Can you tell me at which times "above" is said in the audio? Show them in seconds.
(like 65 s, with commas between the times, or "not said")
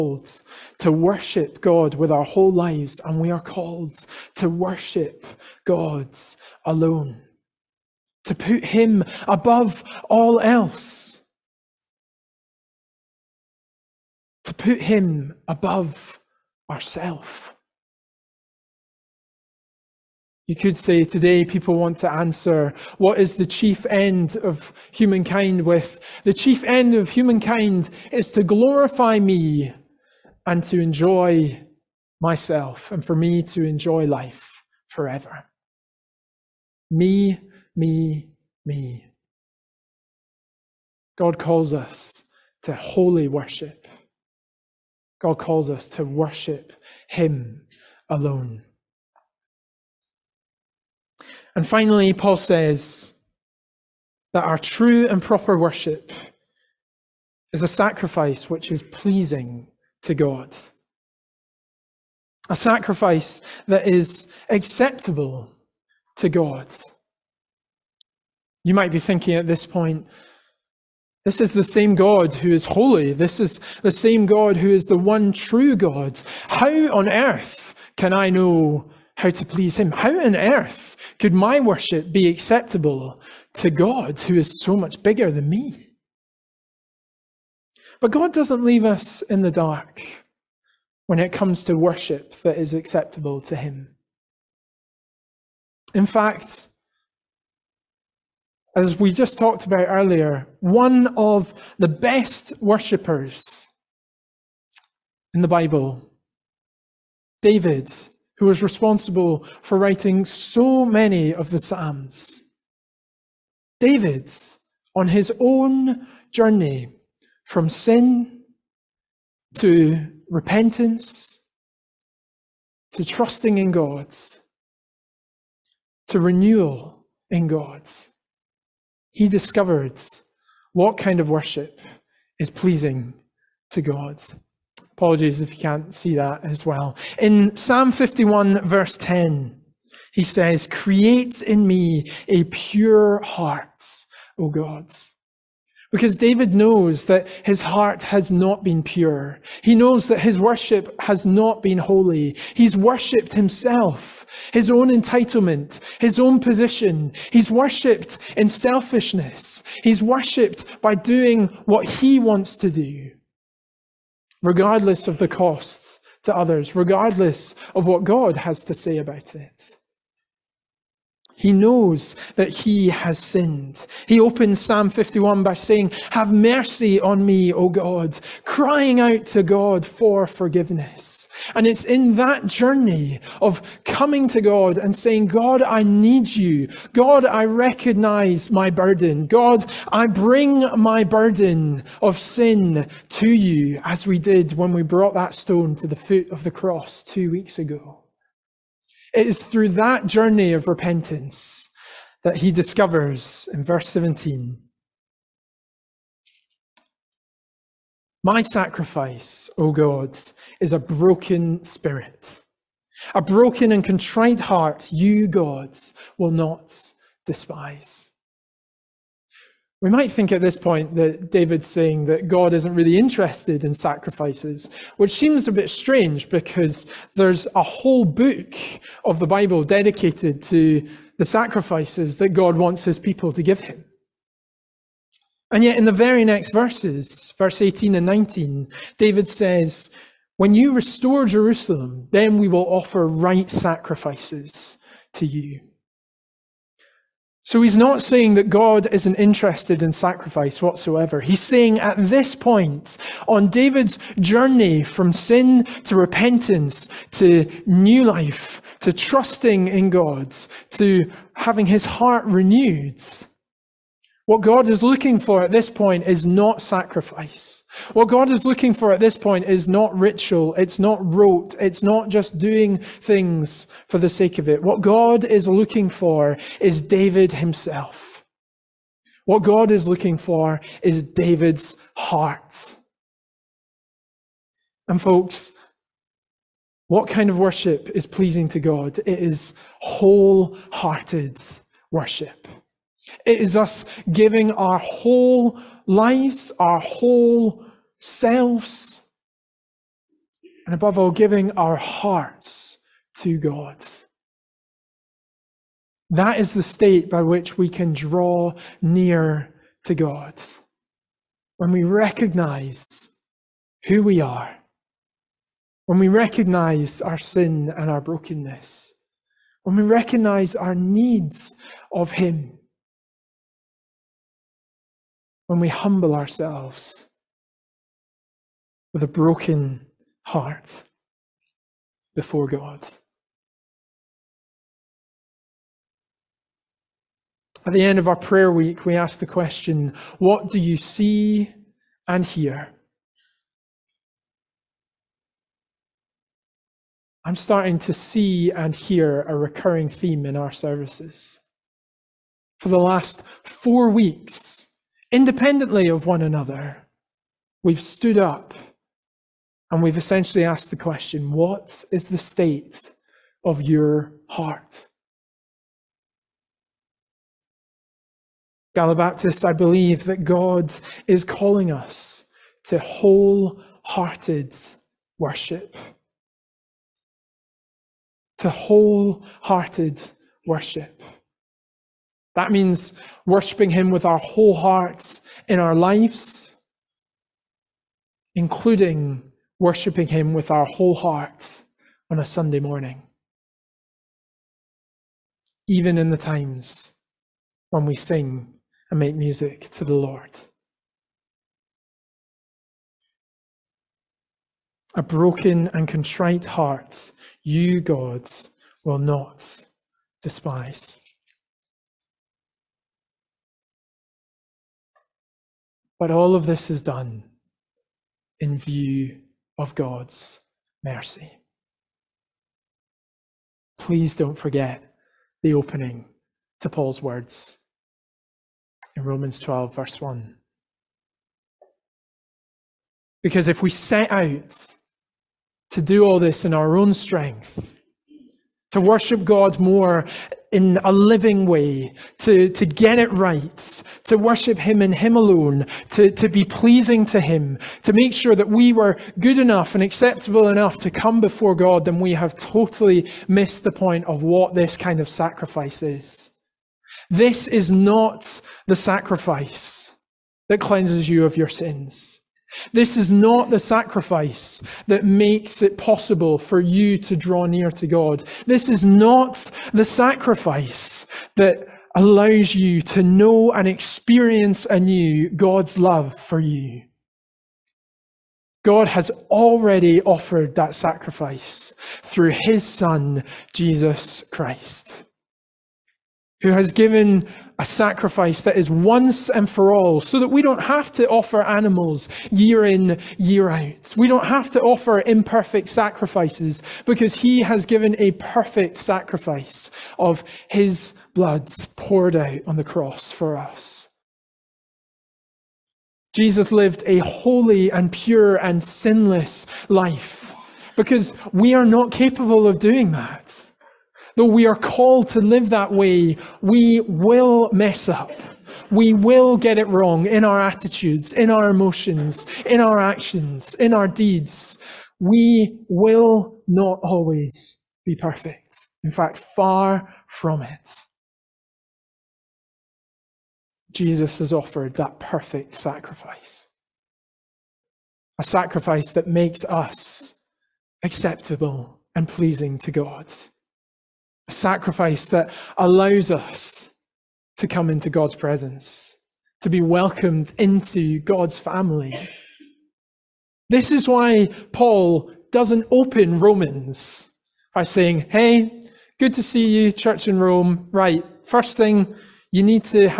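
9 s, 15 s, 300 s.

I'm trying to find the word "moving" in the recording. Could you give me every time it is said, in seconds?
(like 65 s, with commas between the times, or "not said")
not said.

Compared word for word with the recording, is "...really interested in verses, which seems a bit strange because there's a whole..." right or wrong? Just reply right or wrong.
wrong.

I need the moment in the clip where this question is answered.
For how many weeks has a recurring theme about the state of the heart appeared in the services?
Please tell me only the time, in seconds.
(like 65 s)
353 s.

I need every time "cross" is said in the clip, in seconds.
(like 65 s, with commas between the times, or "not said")
196 s, 502 s.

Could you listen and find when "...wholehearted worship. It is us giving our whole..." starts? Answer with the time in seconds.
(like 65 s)
289 s.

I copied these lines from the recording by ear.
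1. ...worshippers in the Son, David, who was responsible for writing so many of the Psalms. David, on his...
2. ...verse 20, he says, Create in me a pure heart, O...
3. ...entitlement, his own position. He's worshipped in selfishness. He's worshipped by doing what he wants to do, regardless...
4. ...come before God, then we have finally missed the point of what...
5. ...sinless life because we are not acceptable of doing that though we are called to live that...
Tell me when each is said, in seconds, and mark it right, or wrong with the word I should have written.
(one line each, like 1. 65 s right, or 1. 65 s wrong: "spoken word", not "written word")
1. 102 s wrong: "Bible", not "Son"
2. 138 s wrong: "10", not "20"
3. 154 s right
4. 450 s wrong: "totally", not "finally"
5. 508 s wrong: "capable", not "acceptable".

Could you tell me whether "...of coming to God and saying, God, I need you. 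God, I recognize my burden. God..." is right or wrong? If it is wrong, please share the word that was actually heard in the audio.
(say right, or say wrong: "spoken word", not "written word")
right.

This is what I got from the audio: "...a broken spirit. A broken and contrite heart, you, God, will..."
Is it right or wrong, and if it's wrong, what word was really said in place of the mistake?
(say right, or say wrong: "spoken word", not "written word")
right.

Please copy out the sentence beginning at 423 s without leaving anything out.
Please don't forget the opening to Paul's words in Romans 12, verse 1.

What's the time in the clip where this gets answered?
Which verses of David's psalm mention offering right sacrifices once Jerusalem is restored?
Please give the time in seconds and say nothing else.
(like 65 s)
237 s.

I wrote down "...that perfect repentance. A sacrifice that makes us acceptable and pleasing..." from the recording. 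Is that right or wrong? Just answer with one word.
wrong.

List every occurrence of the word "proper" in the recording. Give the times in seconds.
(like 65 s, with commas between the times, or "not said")
55 s.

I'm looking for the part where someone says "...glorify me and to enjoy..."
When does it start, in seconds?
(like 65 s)
28 s.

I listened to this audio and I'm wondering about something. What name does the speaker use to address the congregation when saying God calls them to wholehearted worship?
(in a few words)
Galabaptists.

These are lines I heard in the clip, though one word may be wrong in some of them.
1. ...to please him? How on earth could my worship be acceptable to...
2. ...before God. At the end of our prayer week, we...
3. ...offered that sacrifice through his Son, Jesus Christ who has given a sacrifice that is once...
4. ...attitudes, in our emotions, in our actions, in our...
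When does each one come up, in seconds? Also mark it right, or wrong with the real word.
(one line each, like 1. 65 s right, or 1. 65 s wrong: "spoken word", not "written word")
1. 79 s right
2. 332 s right
3. 480 s right
4. 520 s right.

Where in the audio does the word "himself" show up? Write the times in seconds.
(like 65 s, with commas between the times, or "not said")
153 s, 277 s.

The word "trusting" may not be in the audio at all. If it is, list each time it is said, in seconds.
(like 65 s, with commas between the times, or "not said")
123 s, 258 s.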